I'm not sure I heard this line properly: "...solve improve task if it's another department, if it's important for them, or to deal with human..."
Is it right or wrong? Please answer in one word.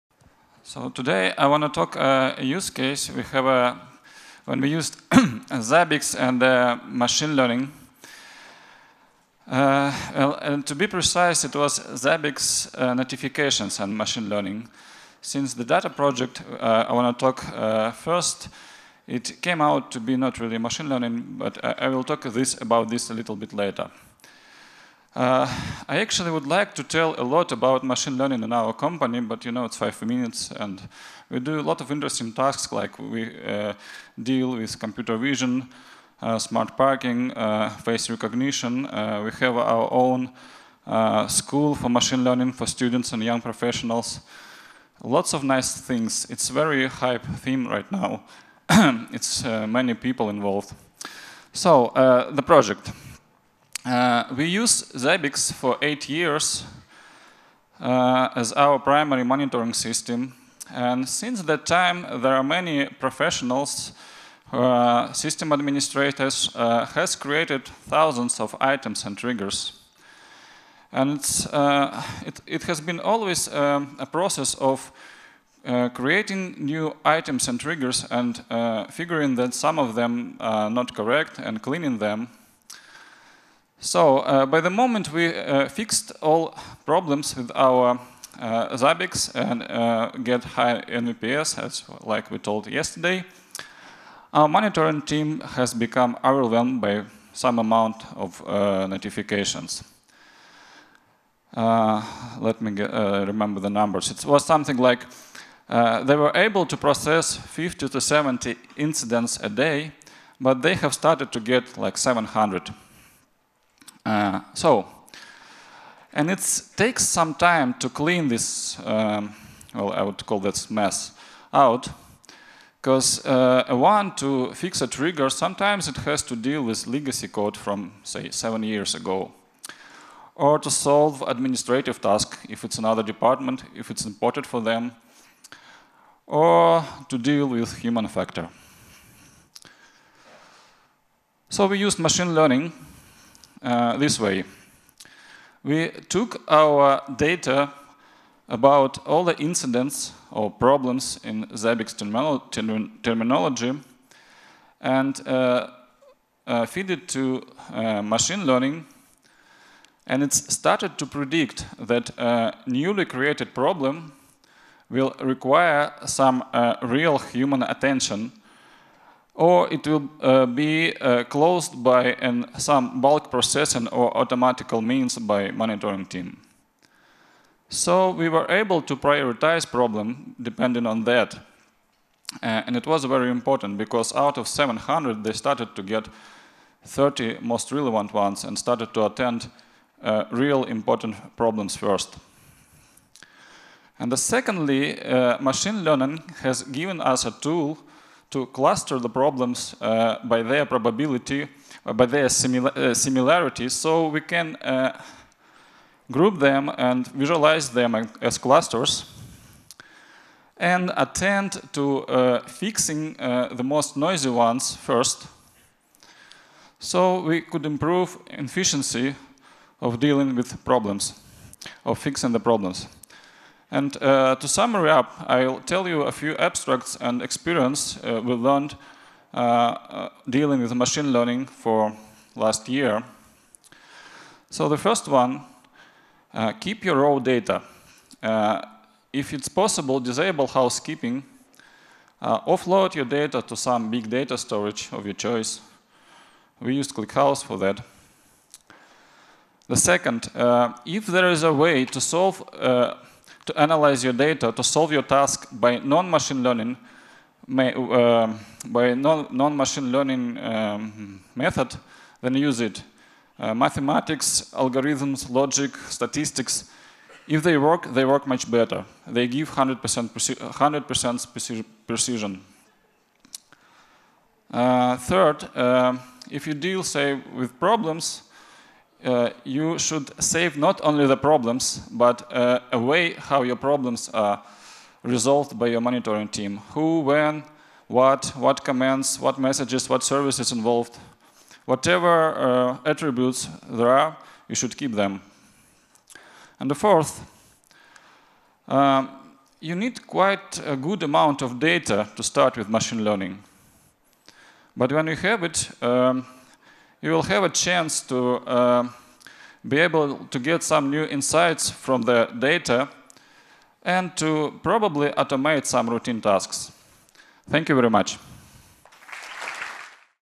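wrong.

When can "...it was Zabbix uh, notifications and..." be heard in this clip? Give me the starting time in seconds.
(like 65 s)
11 s.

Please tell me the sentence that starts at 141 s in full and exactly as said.
So we used machine learning uh, this way.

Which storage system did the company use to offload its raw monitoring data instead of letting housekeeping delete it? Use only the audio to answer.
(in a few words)
ClickHouse.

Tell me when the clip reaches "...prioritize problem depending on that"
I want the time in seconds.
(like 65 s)
178 s.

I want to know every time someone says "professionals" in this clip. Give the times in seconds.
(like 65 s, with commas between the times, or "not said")
43 s, 62 s.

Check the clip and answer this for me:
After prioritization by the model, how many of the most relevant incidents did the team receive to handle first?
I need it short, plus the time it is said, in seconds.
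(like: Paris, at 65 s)
30, at 186 s.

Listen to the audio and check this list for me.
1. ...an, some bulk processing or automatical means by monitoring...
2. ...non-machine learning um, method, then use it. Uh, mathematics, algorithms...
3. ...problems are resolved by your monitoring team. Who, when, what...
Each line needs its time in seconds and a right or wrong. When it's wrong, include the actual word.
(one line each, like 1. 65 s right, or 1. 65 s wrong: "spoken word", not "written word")
1. 172 s right
2. 258 s right
3. 283 s right.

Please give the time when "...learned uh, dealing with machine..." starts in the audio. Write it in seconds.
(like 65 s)
228 s.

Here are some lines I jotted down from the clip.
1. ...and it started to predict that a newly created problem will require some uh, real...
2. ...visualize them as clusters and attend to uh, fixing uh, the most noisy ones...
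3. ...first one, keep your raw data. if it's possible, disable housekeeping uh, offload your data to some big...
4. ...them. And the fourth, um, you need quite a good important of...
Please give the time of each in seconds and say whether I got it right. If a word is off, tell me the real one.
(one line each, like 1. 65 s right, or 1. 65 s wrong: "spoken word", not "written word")
1. 160 s right
2. 207 s right
3. 234 s right
4. 294 s wrong: "amount", not "important".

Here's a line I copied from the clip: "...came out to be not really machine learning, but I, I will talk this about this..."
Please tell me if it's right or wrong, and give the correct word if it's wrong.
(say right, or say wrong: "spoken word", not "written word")
right.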